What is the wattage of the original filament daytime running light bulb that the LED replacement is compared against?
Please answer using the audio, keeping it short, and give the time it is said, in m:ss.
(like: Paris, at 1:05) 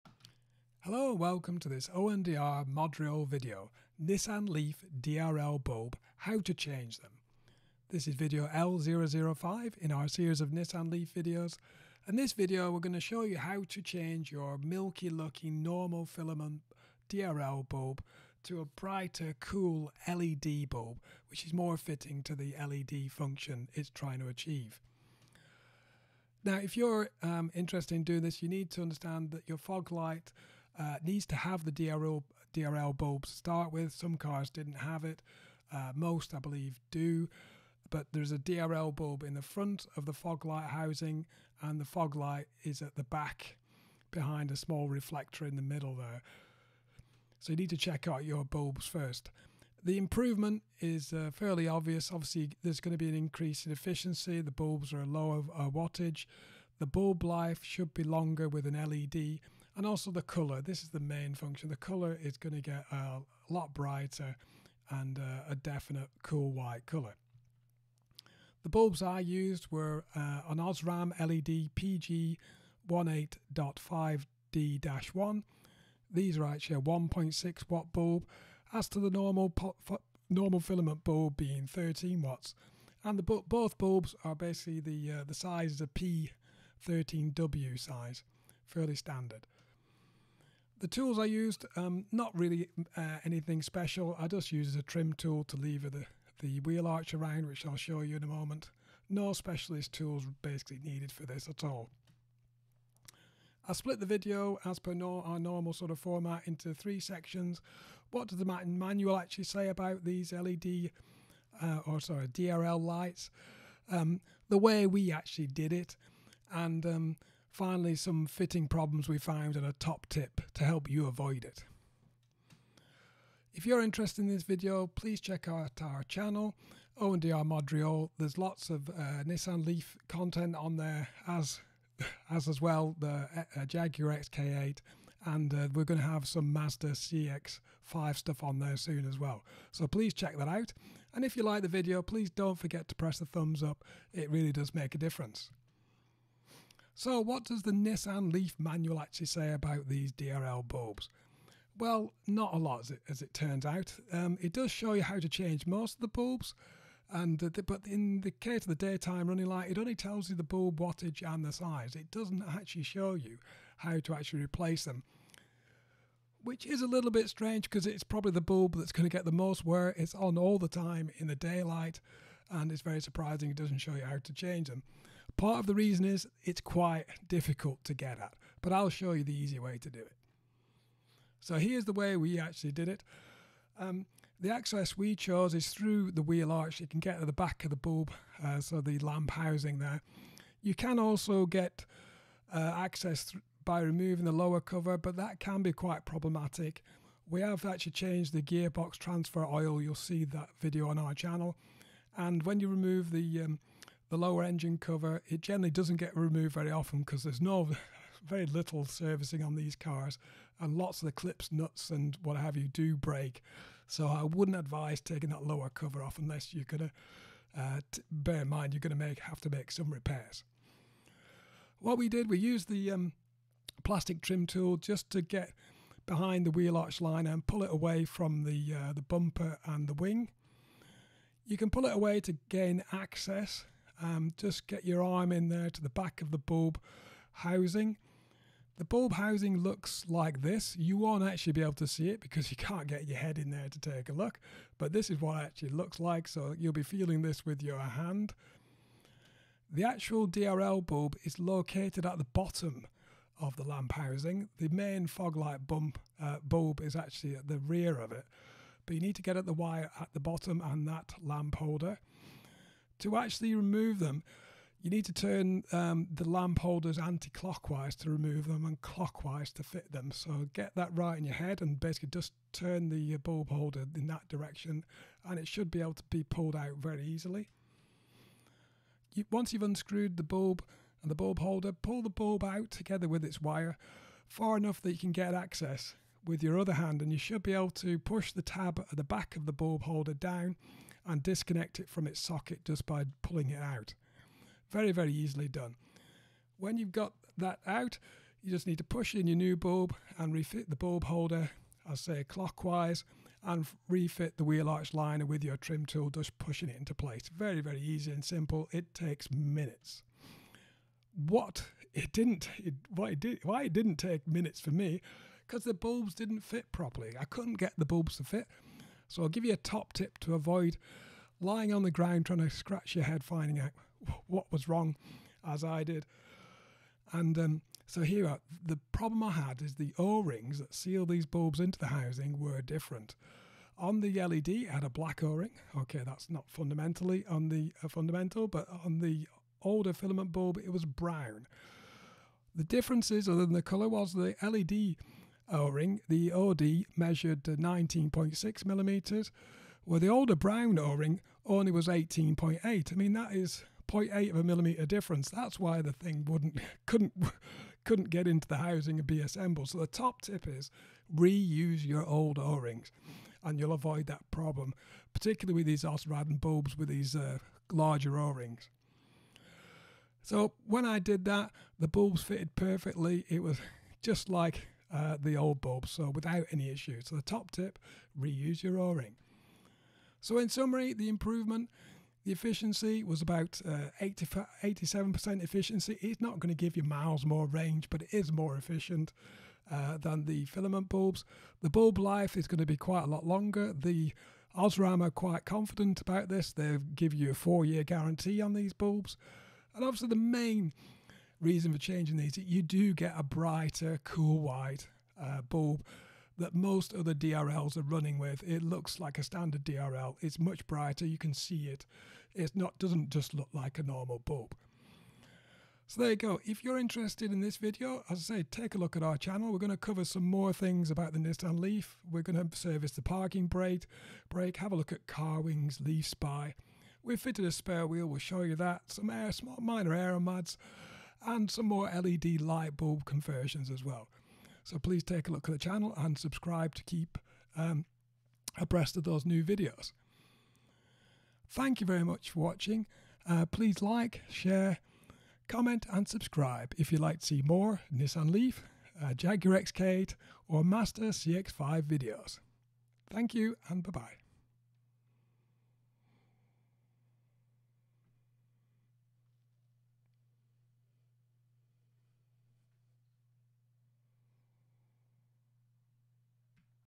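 13 watts, at 1:21.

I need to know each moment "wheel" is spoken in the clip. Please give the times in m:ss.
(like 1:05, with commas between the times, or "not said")
1:36, 3:06, 3:46, 5:04, 7:07.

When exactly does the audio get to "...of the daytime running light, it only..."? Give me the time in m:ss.
2:38.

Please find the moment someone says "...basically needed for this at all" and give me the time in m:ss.
1:40.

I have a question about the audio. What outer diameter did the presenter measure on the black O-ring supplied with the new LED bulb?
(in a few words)
19.6 millimeters.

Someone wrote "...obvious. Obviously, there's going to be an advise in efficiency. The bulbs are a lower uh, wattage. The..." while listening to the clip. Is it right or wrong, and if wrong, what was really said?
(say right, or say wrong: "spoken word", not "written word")
wrong: "increase", not "advise".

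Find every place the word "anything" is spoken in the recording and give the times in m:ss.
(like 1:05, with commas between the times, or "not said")
1:33.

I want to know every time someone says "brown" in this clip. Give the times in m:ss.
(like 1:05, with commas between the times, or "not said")
5:40, 5:50.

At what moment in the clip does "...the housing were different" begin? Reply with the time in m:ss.
5:31.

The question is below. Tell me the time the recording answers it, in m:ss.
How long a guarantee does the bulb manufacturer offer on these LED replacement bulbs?
6:37.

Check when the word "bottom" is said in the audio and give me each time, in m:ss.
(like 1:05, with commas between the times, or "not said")
4:12, 4:20.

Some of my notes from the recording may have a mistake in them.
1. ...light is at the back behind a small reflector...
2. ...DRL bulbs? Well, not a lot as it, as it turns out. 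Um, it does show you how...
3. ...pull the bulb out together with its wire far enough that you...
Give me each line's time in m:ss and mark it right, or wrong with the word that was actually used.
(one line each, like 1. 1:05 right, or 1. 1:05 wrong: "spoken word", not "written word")
1. 0:42 right
2. 2:30 right
3. 4:41 right.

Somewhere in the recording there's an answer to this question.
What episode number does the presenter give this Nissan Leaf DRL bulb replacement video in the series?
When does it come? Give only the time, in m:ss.
0:08.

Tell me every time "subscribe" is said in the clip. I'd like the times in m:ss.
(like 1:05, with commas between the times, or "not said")
7:16, 7:26.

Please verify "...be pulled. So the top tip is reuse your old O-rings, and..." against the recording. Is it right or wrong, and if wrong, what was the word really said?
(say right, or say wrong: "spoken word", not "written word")
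wrong: "assembled", not "pulled".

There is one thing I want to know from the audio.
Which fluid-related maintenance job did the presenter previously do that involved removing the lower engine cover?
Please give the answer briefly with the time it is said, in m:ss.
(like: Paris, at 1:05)
gearbox transfer oil, at 3:18.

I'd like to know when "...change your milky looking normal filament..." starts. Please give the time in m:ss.
0:13.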